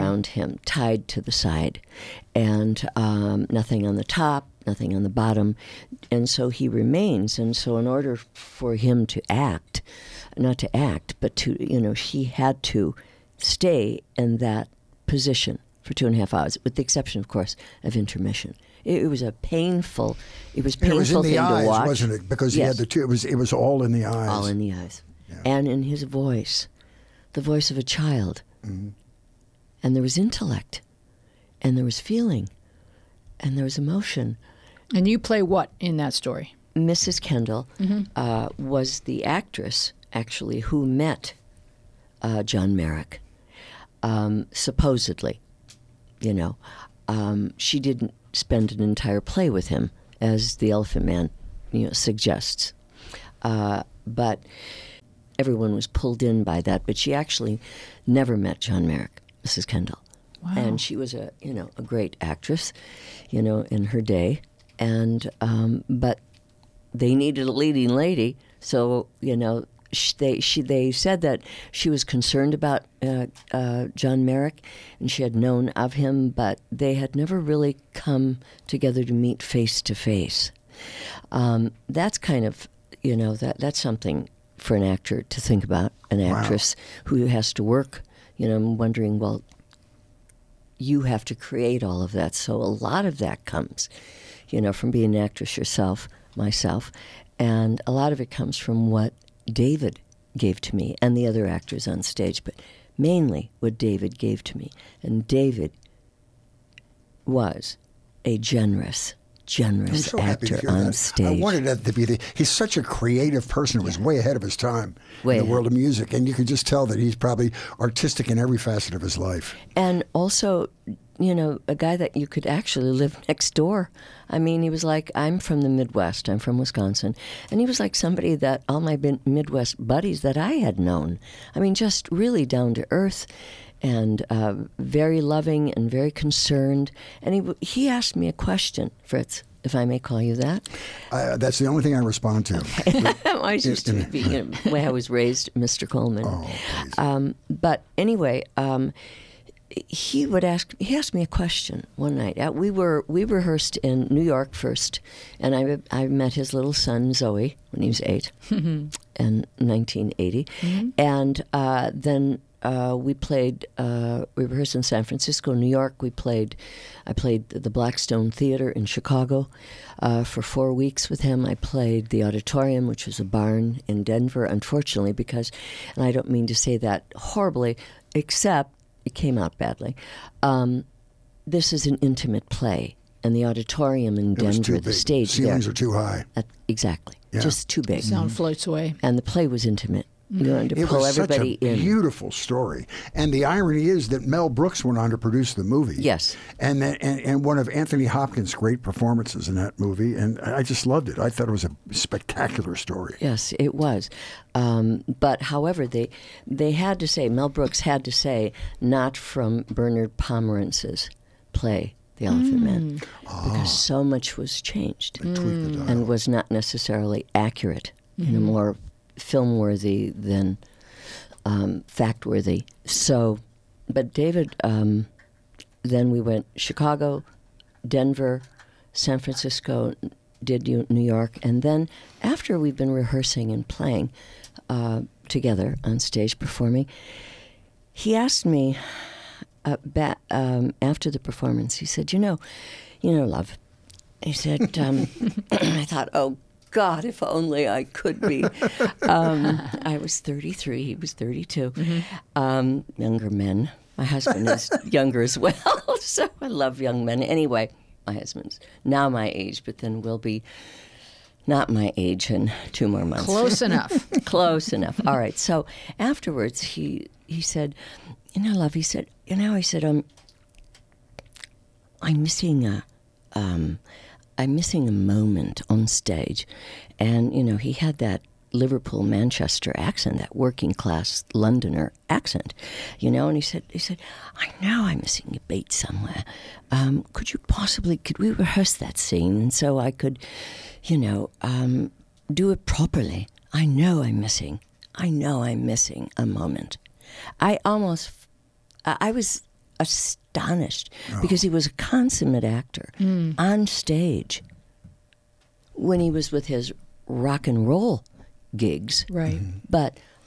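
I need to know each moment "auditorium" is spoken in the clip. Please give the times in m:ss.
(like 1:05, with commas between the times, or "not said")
2:52, 3:03.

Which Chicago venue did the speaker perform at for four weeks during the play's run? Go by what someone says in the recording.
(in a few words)
Blackstone Theater.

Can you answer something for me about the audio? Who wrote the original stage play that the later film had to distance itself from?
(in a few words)
Bernard Pomerance.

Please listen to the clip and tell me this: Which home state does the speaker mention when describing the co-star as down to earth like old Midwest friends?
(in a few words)
Wisconsin.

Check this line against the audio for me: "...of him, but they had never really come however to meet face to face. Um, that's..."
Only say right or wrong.
wrong.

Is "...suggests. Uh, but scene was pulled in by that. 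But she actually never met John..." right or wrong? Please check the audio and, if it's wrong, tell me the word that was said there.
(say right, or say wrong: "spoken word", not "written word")
wrong: "everyone", not "scene".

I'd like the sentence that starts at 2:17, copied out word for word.
And he, he asked me a question, Fritz.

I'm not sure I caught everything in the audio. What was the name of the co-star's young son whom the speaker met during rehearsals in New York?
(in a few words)
Zowie.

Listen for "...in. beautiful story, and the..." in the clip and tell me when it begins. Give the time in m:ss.
3:11.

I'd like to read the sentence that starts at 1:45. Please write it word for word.
And David was a generous generous so actor on that.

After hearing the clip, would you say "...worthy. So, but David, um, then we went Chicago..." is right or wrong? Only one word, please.
right.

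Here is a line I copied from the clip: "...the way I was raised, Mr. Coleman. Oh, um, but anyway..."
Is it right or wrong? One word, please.
right.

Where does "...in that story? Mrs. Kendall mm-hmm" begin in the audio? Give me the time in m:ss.
0:35.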